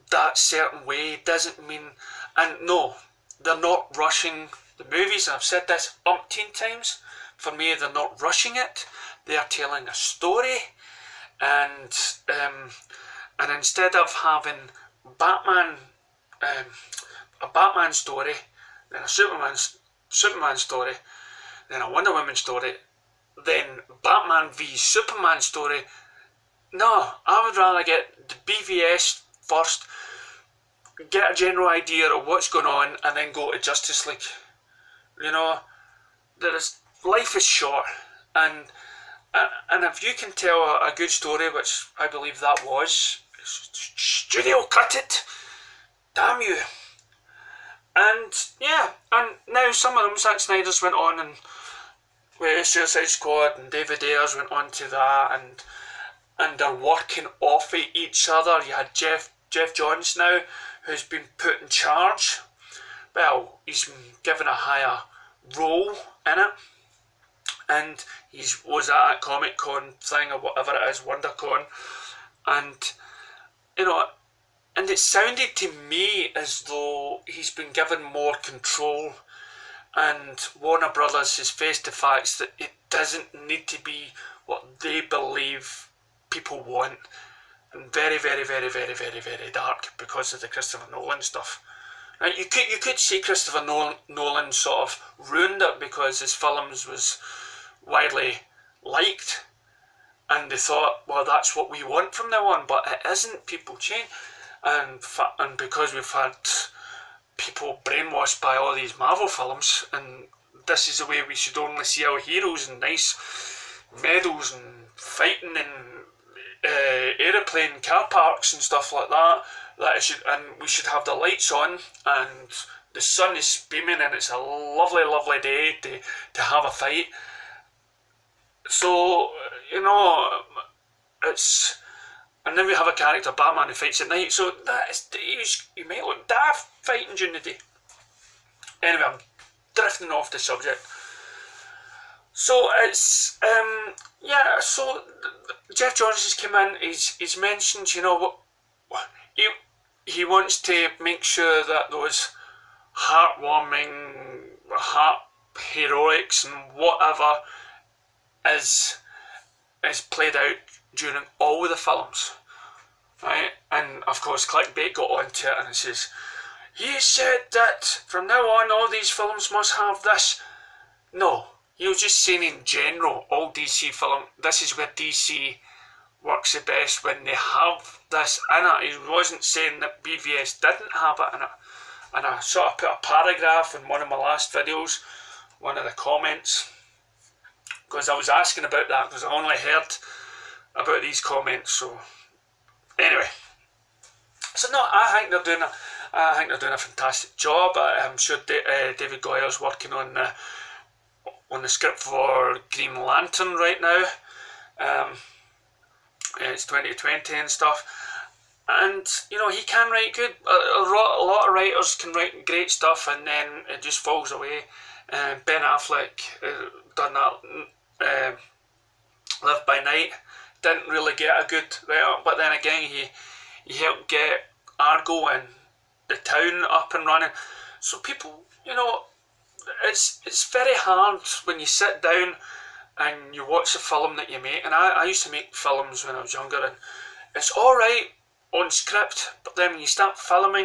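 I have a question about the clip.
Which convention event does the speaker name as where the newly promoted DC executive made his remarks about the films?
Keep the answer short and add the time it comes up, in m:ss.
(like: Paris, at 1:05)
WonderCon, at 1:10.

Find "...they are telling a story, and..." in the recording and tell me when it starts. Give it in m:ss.
0:09.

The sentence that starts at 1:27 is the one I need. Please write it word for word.
And very, very, very, very, very, very dark because of the Christopher Nolan stuff.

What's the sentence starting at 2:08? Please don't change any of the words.
So, you know, it's and then we have a character Batman who fights at night.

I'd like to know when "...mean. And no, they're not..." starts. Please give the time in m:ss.
0:01.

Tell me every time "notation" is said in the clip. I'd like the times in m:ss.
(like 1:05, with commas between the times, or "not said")
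not said.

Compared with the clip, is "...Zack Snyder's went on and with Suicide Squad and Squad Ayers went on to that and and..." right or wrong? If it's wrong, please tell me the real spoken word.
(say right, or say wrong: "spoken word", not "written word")
wrong: "David", not "Squad".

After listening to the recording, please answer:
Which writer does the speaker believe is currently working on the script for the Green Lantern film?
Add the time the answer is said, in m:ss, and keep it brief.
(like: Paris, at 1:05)
David Goyer, at 3:18.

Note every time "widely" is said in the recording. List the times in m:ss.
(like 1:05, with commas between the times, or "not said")
1:37.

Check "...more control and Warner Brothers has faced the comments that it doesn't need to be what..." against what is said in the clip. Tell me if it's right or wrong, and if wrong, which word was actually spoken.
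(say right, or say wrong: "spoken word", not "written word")
wrong: "facts", not "comments".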